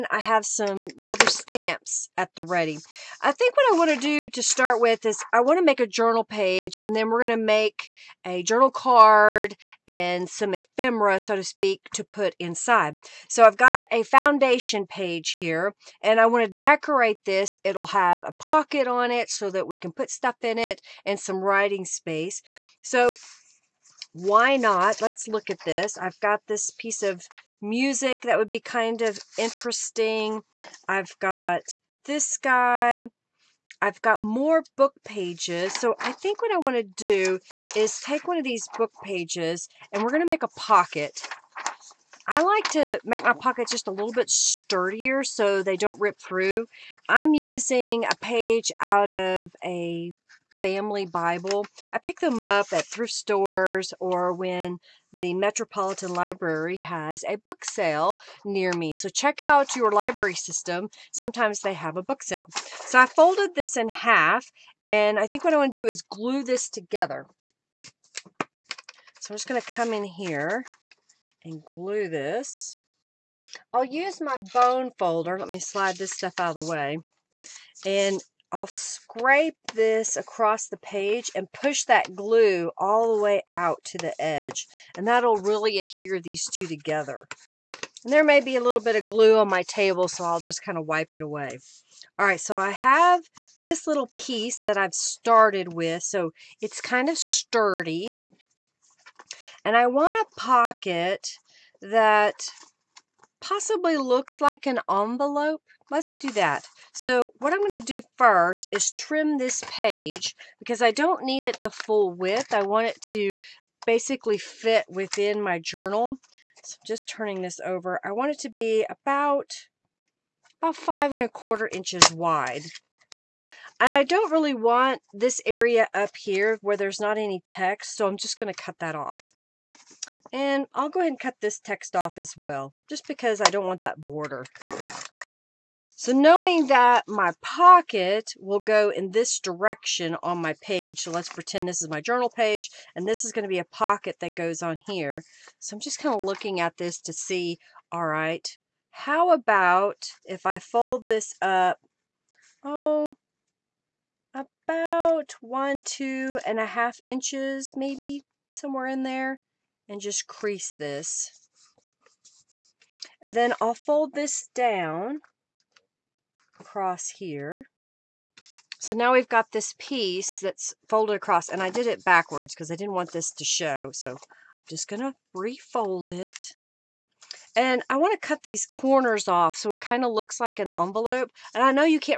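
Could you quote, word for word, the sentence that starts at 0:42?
I like to make my pockets just a little bit sturdier so they don't rip through.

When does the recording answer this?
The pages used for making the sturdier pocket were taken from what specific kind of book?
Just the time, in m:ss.
0:50.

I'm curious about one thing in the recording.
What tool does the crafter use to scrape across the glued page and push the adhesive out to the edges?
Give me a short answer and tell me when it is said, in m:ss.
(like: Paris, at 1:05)
bone folder, at 1:14.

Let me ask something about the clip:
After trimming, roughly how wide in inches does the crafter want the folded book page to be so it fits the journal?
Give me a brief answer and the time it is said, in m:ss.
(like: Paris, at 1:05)
5 1/4 inches, at 2:00.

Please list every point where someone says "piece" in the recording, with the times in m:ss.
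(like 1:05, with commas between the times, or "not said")
0:26, 1:34, 2:49.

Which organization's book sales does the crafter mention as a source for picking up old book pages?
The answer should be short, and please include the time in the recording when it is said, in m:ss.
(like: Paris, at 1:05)
Metropolitan Library, at 0:55.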